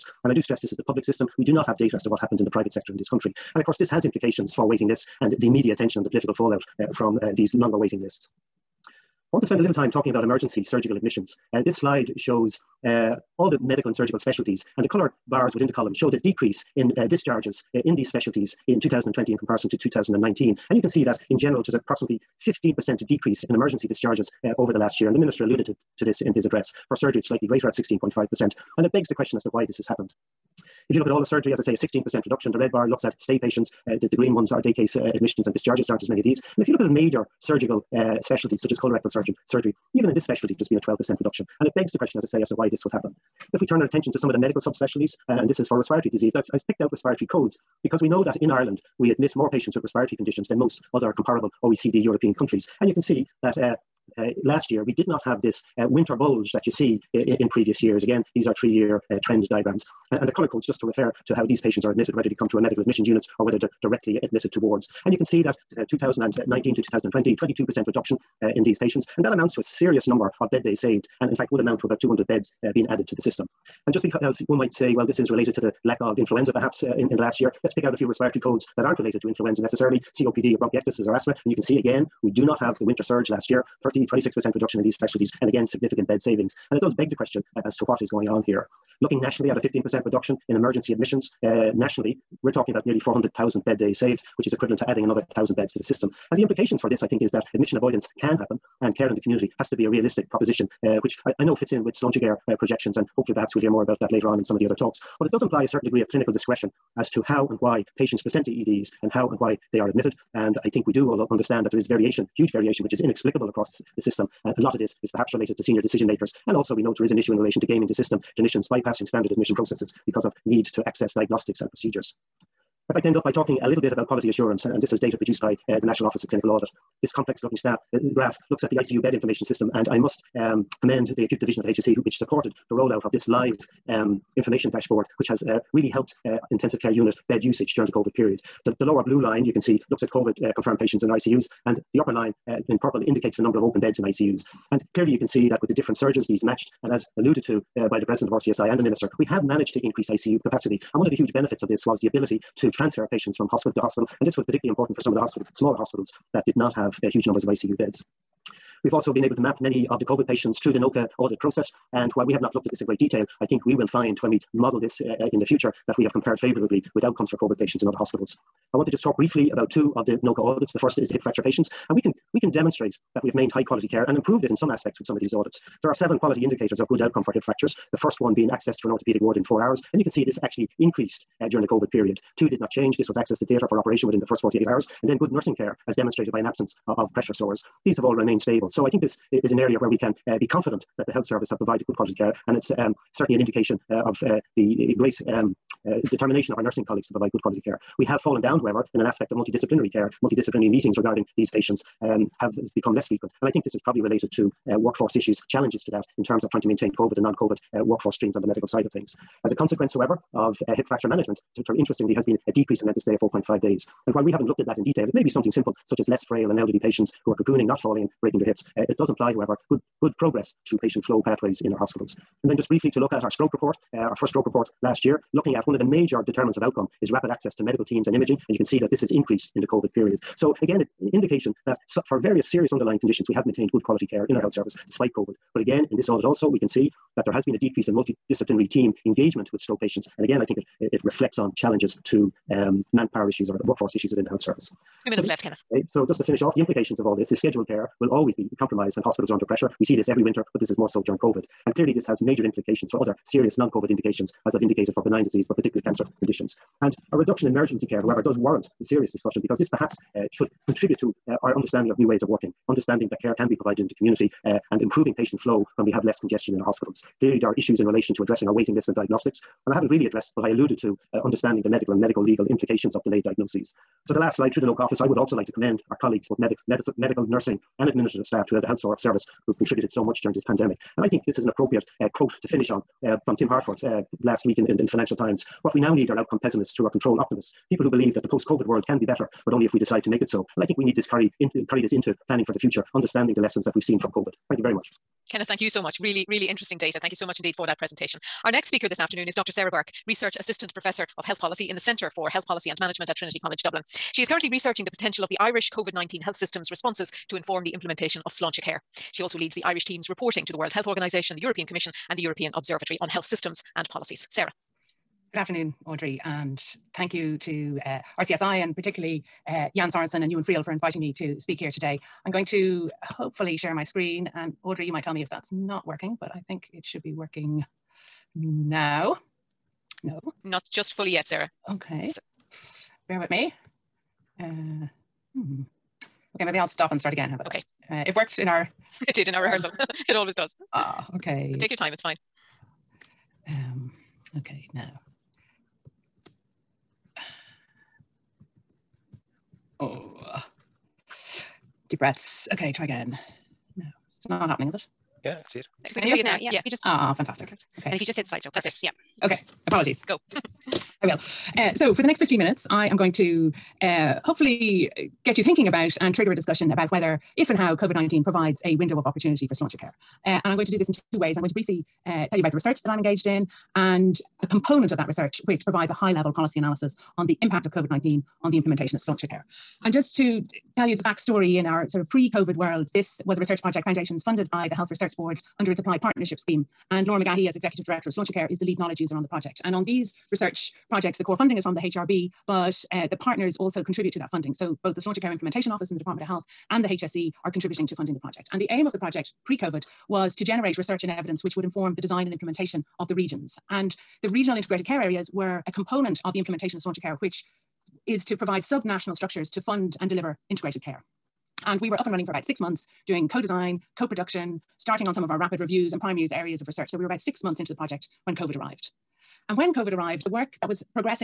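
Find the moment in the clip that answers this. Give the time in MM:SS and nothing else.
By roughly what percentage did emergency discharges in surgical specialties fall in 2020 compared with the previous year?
00:27.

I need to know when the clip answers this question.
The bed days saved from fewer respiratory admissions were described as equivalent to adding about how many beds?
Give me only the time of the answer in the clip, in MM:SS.
01:11.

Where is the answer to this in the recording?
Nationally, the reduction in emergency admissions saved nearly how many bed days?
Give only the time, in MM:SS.
01:32.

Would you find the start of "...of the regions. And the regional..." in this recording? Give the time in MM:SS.
06:42.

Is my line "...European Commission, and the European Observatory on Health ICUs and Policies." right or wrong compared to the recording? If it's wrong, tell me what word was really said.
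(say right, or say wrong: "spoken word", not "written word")
wrong: "Systems", not "ICUs".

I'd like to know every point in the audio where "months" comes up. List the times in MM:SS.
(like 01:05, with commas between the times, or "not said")
06:52, 06:57.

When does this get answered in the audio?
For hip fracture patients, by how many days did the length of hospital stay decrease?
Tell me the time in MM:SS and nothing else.
03:33.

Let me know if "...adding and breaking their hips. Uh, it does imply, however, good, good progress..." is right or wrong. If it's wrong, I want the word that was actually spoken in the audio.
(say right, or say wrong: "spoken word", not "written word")
wrong: "falling", not "adding".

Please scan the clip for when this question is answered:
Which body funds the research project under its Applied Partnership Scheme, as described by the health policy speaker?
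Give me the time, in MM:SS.
06:24.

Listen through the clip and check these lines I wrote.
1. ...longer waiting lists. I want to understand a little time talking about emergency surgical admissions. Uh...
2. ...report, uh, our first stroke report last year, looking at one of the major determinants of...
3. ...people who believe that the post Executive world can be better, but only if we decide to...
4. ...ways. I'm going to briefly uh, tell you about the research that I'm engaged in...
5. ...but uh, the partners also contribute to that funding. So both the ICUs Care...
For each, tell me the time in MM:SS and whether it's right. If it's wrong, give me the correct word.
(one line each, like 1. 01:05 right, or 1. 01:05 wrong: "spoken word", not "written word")
1. 00:07 wrong: "spend", not "understand"
2. 03:43 right
3. 04:47 wrong: "COVID", not "Executive"
4. 06:11 right
5. 06:32 wrong: "Sláinte", not "ICUs".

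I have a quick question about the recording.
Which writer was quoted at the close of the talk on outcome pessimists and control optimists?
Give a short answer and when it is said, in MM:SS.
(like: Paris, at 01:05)
Tim Harford, at 04:43.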